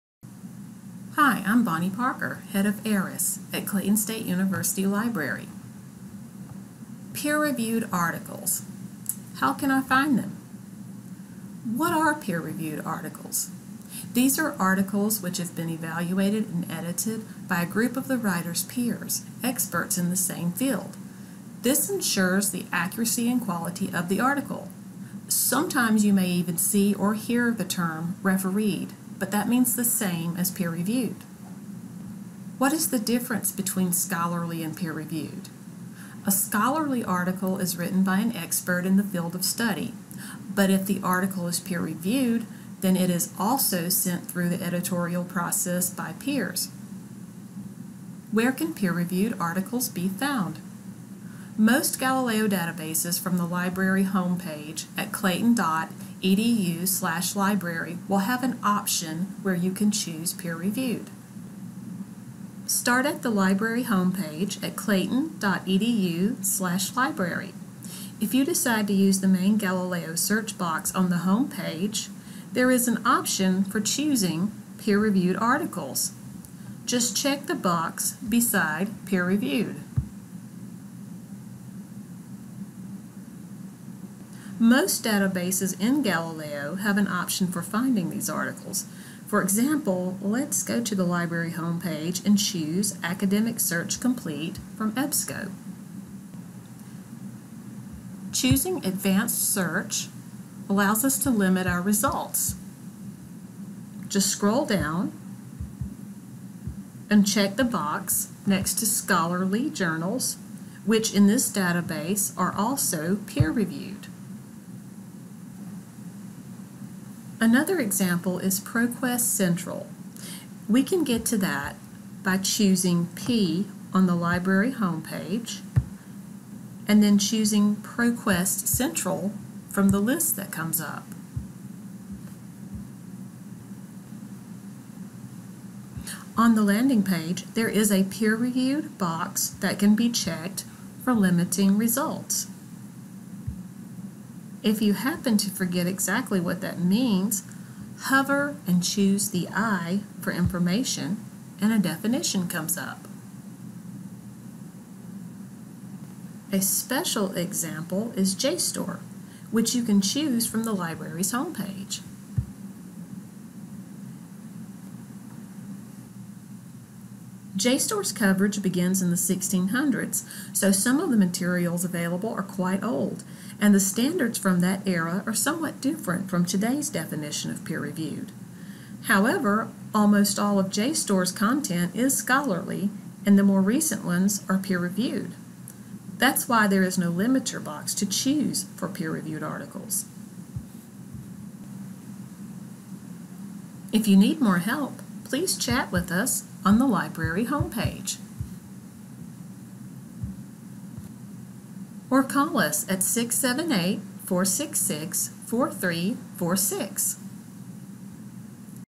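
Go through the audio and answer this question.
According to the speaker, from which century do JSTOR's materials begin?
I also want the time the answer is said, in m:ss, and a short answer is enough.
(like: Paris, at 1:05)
1600s, at 2:49.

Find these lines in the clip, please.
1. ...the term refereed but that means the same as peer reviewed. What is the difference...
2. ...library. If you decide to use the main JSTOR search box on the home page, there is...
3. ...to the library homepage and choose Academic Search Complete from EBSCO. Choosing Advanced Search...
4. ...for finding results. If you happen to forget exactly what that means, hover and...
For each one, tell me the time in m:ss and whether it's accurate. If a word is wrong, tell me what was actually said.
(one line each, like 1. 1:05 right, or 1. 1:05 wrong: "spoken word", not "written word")
1. 0:27 right
2. 1:06 wrong: "Galileo", not "JSTOR"
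3. 1:30 right
4. 2:21 wrong: "limiting", not "finding".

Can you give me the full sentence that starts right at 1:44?
Just scroll down and check the box next to scholarly journals, which in this database are also peer-reviewed.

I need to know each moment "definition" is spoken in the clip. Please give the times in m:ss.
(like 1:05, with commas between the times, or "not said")
2:31, 2:56.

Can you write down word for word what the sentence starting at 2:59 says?
However, almost all of JSTOR's content is scholarly, and the more recent ones are peer-reviewed.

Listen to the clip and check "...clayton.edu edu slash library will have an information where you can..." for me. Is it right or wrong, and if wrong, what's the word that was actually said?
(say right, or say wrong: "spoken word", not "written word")
wrong: "option", not "information".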